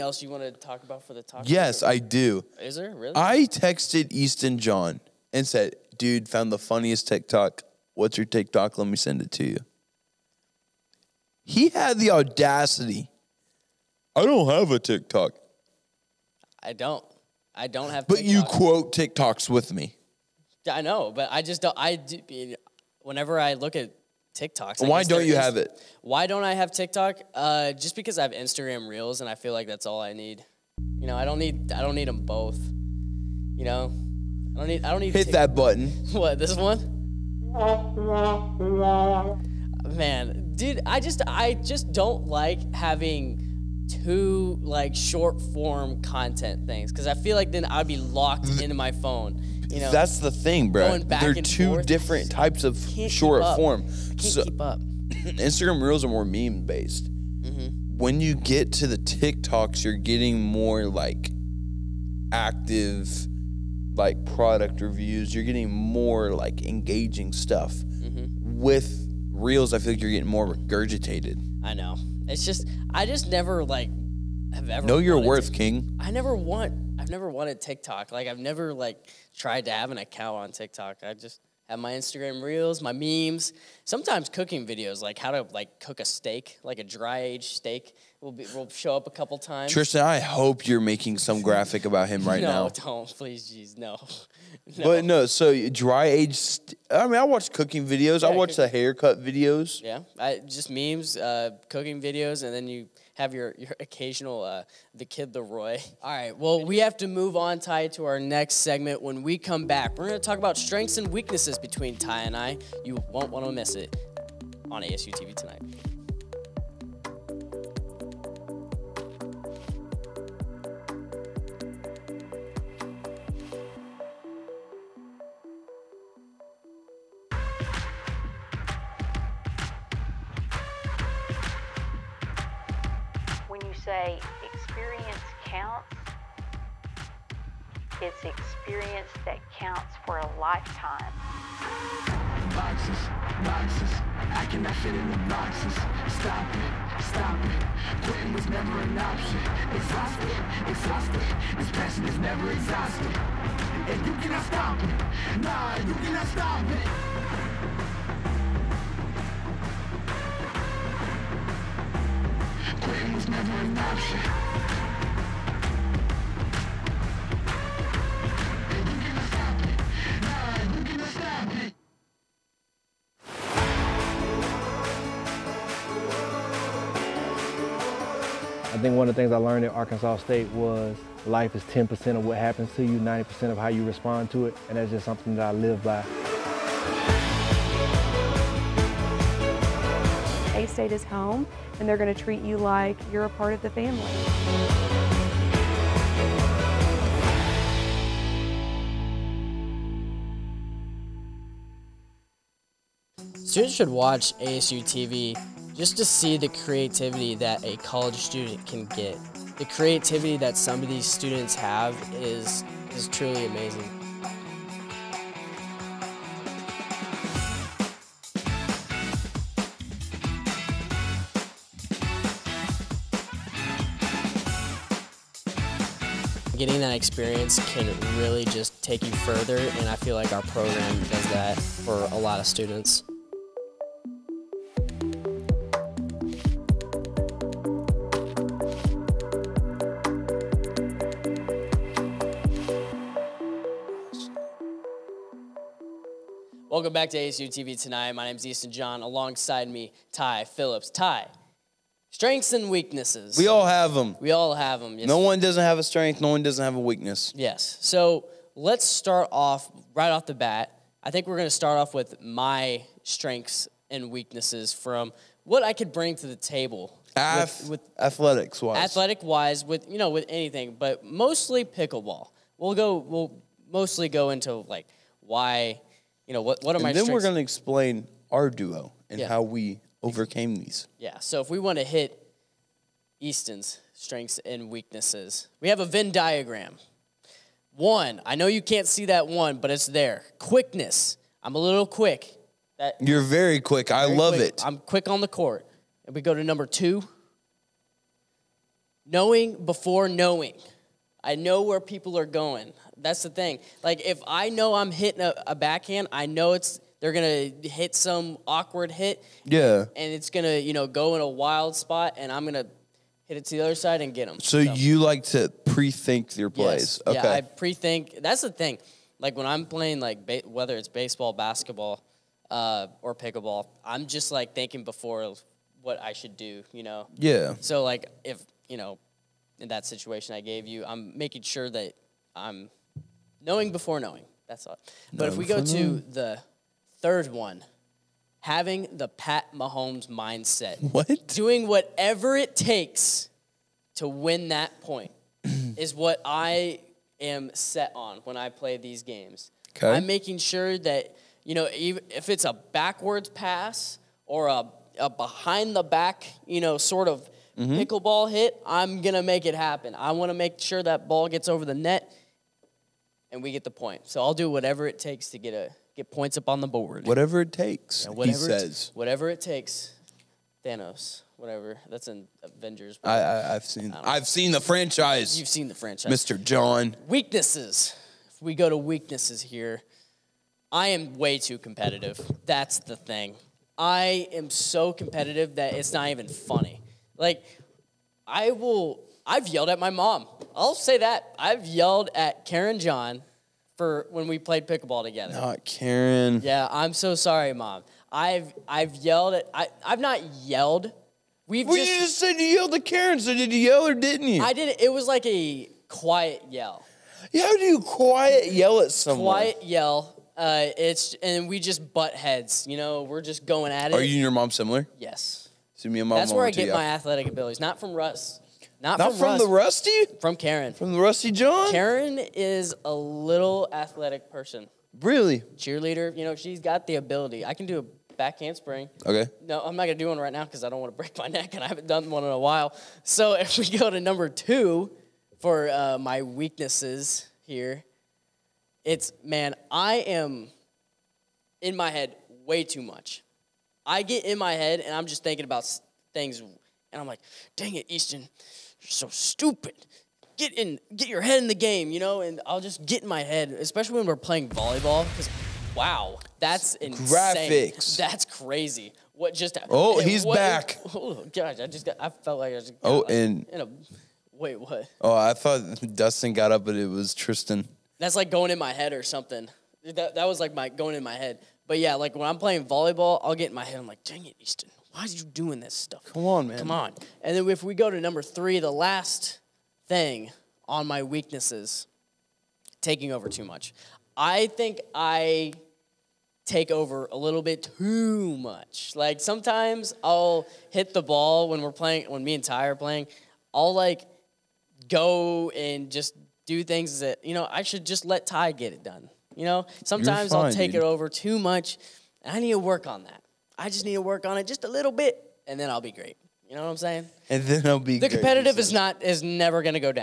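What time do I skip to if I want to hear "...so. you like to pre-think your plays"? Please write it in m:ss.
5:14.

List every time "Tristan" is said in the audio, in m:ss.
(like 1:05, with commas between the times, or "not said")
1:29, 7:47.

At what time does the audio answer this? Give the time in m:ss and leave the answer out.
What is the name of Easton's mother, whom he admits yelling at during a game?
6:32.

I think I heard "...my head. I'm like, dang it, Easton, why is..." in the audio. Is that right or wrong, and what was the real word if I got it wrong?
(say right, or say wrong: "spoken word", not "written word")
right.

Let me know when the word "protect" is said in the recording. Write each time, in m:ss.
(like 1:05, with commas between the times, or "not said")
not said.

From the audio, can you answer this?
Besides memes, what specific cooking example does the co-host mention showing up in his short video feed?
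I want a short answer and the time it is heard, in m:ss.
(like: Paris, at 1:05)
dry aged steak, at 1:26.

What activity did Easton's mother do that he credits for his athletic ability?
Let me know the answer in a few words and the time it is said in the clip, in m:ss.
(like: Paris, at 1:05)
Cheerleader, at 7:05.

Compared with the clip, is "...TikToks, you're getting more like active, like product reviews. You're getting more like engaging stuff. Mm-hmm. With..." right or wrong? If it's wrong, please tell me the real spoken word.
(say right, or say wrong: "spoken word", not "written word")
right.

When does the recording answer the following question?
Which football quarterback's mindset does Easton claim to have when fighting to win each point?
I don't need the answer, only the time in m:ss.
5:39.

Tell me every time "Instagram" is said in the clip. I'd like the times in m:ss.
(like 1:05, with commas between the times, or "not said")
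0:28, 0:55, 1:21.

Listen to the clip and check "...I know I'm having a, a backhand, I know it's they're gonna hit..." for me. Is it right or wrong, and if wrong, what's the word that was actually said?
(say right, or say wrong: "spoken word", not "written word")
wrong: "hitting", not "having".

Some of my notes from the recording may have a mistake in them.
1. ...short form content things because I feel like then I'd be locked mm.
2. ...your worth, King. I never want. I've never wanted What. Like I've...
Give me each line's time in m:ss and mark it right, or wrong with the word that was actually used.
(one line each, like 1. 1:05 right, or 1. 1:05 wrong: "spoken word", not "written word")
1. 0:44 right
2. 1:14 wrong: "TikTok", not "What".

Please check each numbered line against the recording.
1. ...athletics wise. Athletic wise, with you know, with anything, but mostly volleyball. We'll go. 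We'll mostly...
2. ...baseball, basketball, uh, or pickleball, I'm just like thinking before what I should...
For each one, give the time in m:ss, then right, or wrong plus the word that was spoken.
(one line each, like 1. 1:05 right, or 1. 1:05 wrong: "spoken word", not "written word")
1. 4:27 wrong: "pickleball", not "volleyball"
2. 5:20 right.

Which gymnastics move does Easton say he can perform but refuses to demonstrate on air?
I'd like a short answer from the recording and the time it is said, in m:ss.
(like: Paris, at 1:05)
back handspring, at 7:08.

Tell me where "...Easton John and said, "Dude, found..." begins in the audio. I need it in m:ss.
0:04.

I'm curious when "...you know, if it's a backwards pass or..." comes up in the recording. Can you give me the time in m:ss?
5:51.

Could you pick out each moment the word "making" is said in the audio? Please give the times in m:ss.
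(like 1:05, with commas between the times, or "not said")
1:30, 5:31, 5:50.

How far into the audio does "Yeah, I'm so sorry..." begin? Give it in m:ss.
6:36.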